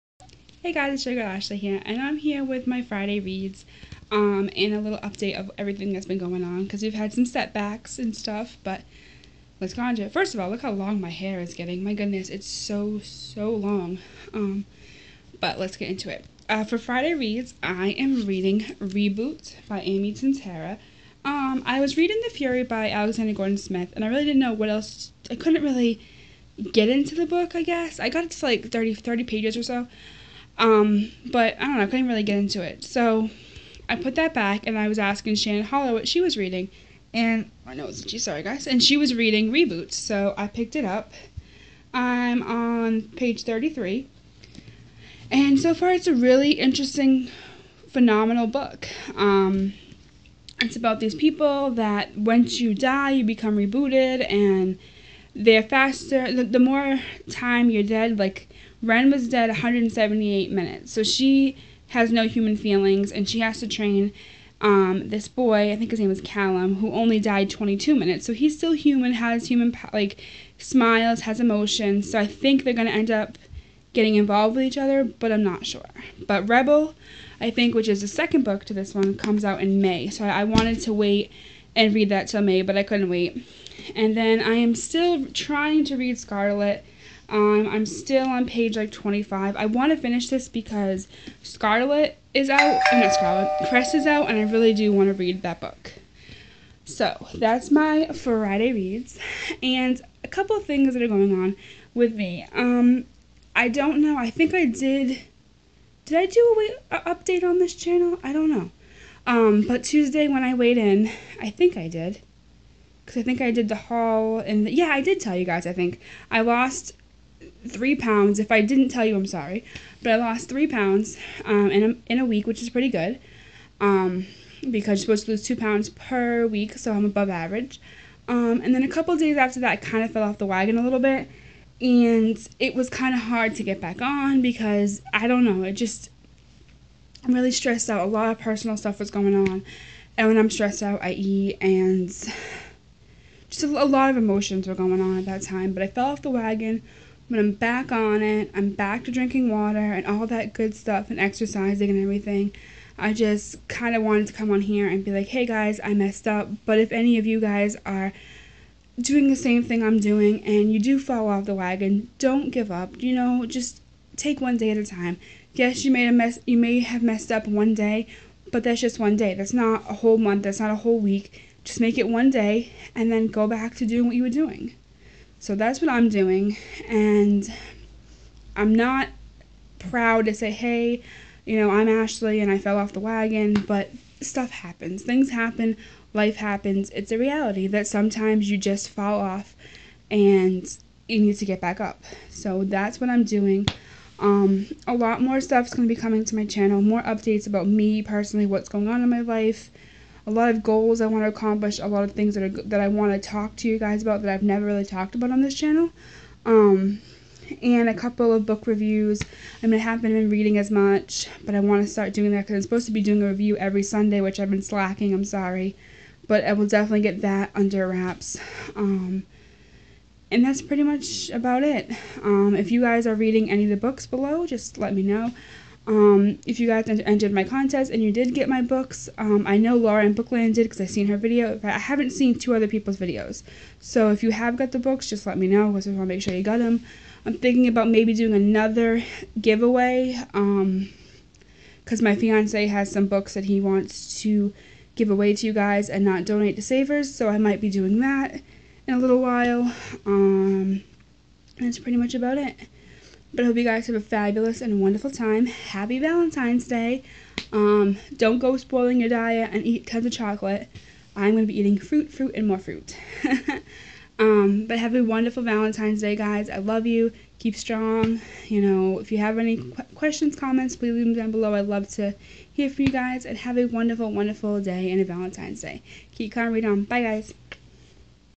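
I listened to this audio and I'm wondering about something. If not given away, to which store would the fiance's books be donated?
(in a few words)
Savers.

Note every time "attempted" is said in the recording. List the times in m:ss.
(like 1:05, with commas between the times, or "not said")
not said.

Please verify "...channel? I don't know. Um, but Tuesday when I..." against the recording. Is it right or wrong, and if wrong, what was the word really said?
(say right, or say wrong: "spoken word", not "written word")
right.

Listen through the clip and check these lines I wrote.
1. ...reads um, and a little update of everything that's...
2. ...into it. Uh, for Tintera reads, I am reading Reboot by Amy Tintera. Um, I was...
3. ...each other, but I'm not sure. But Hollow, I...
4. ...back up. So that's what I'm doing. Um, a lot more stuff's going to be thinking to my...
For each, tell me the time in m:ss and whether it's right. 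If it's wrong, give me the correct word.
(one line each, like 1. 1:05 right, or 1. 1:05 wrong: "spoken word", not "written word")
1. 0:03 right
2. 0:15 wrong: "Friday", not "Tintera"
3. 1:14 wrong: "Rebel", not "Hollow"
4. 3:11 wrong: "coming", not "thinking".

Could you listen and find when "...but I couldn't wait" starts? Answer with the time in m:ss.
1:22.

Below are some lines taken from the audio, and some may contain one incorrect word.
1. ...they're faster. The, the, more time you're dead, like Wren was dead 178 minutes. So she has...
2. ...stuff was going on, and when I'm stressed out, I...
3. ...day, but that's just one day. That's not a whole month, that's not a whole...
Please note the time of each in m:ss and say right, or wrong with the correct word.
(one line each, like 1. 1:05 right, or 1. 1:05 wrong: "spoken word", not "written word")
1. 0:55 right
2. 2:18 right
3. 2:47 right.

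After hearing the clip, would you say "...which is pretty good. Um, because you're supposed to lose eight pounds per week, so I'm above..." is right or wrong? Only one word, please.
wrong.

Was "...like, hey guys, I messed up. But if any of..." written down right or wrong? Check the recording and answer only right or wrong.
right.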